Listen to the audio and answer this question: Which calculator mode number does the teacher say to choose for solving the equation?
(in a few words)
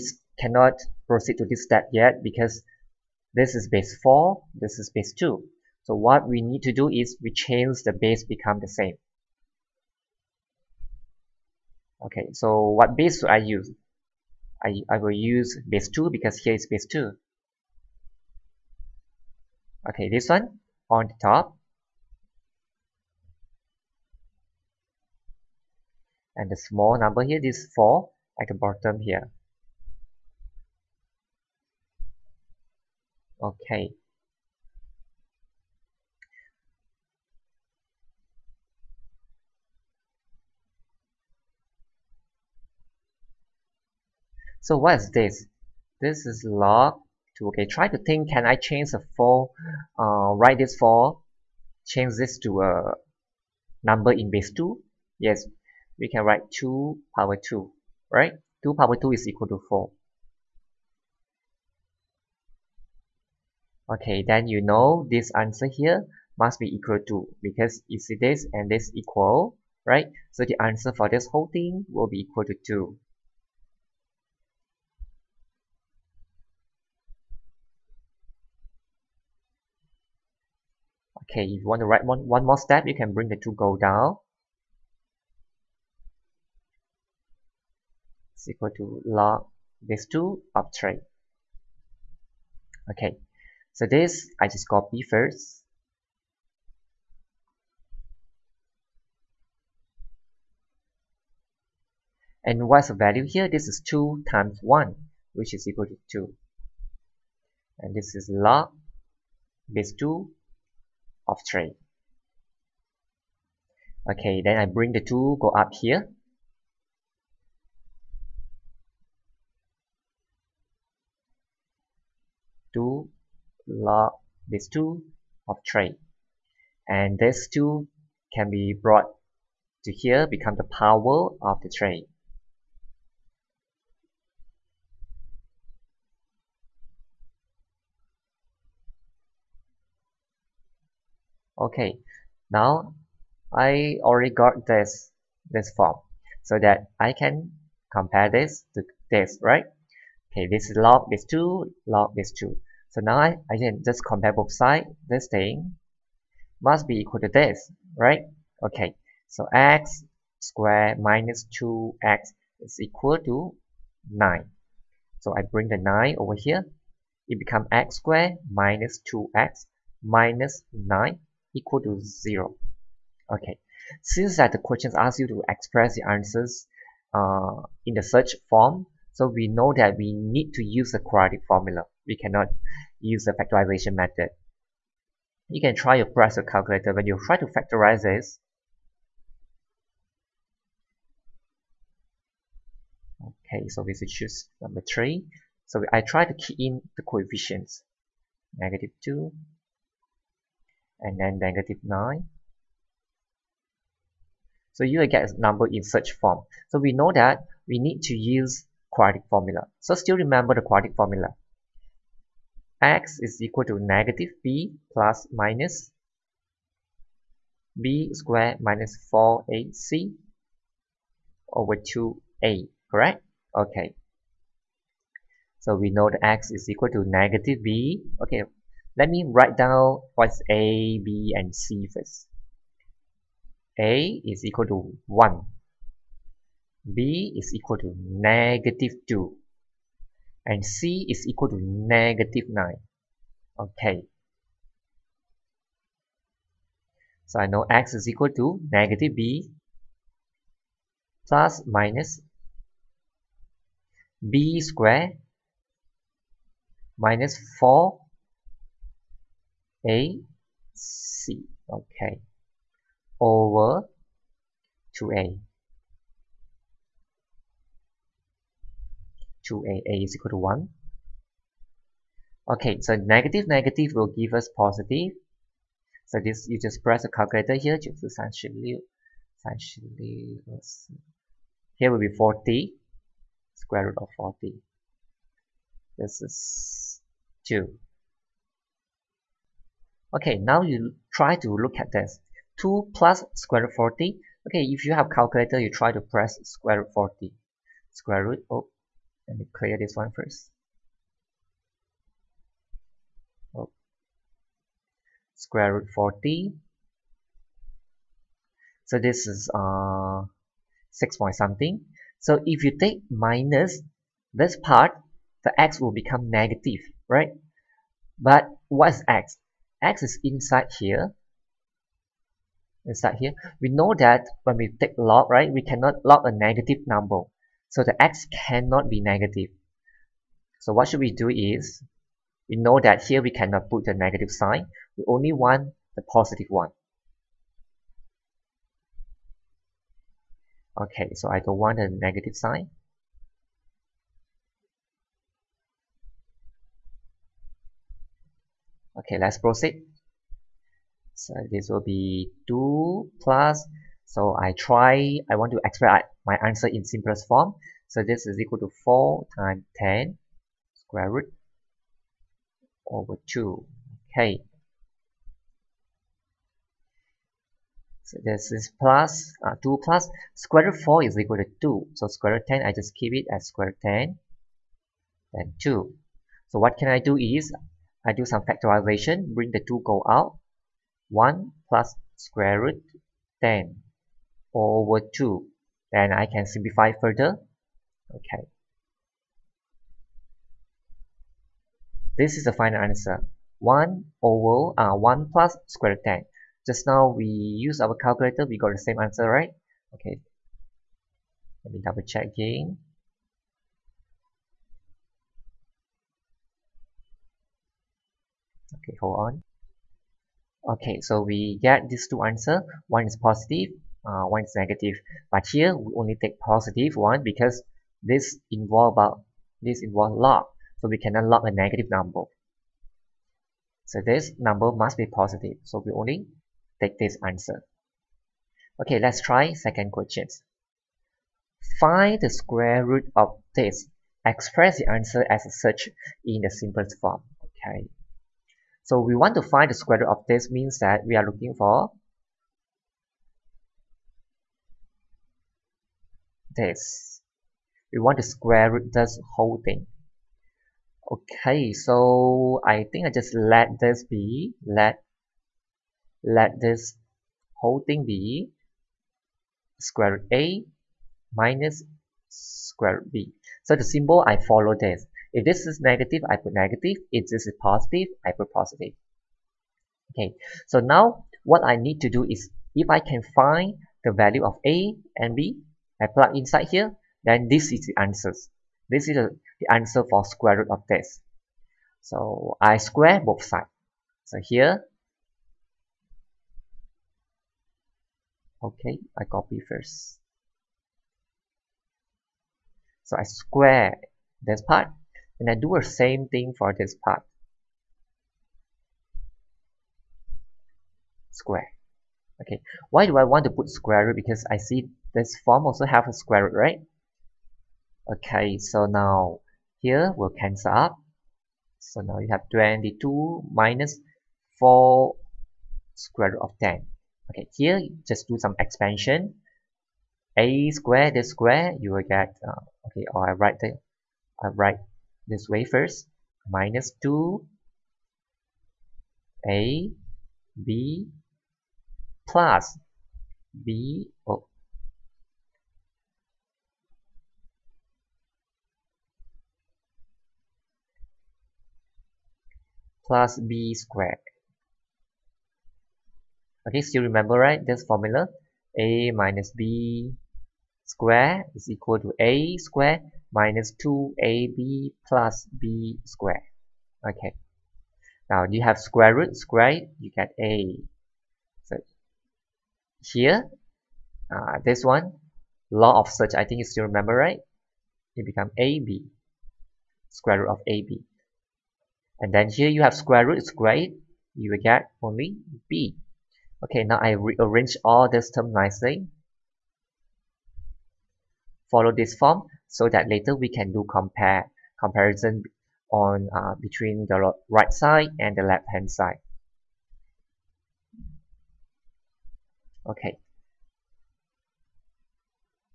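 3.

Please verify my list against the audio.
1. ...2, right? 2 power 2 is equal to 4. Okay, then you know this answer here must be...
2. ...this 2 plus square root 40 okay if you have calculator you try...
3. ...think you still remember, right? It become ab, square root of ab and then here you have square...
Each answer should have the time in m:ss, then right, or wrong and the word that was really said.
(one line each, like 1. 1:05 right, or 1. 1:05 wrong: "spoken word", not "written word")
1. 0:57 right
2. 4:51 right
3. 9:26 right.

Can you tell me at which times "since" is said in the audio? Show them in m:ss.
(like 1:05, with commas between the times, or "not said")
2:54.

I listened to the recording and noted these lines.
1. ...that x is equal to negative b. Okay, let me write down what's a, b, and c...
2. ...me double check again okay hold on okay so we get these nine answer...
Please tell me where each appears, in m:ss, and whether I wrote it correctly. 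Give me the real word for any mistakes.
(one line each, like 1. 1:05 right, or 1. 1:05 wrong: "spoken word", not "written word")
1. 3:46 right
2. 6:41 wrong: "two", not "nine".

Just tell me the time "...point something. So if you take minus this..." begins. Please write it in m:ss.
5:11.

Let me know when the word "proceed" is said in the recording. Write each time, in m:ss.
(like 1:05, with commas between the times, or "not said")
0:01, 5:49.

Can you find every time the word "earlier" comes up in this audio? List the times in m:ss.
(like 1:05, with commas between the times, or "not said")
not said.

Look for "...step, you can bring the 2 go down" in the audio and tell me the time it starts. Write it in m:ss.
1:22.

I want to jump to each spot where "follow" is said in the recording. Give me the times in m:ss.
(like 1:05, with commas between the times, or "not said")
7:44, 9:41.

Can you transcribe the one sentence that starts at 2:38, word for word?
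Okay, so x squared minus 2x is equal to 9.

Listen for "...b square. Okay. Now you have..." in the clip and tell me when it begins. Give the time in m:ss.
9:15.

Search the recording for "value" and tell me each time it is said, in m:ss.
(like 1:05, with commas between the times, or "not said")
1:42, 7:54.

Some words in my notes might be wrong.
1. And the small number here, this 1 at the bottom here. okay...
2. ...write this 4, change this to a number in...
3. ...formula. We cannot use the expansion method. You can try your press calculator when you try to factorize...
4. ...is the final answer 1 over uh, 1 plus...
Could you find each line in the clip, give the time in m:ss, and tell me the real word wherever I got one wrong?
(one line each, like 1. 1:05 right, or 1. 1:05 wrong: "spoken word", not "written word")
1. 0:26 wrong: "4", not "1"
2. 0:50 right
3. 3:01 wrong: "factorization", not "expansion"
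4. 6:32 right.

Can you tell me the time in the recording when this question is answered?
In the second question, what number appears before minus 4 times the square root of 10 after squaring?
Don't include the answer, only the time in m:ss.
8:32.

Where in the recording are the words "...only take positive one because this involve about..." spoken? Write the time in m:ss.
6:55.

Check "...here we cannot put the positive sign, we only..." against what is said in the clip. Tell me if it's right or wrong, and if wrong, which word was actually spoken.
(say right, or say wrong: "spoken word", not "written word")
wrong: "negative", not "positive".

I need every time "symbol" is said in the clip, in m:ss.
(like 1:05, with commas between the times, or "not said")
7:43.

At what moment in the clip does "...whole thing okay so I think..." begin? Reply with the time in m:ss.
7:29.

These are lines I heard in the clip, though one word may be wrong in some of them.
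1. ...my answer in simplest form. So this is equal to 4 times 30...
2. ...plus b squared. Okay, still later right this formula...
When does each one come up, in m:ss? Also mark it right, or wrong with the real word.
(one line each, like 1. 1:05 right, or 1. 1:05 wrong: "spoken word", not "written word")
1. 5:56 wrong: "10", not "30"
2. 9:03 wrong: "remember", not "later".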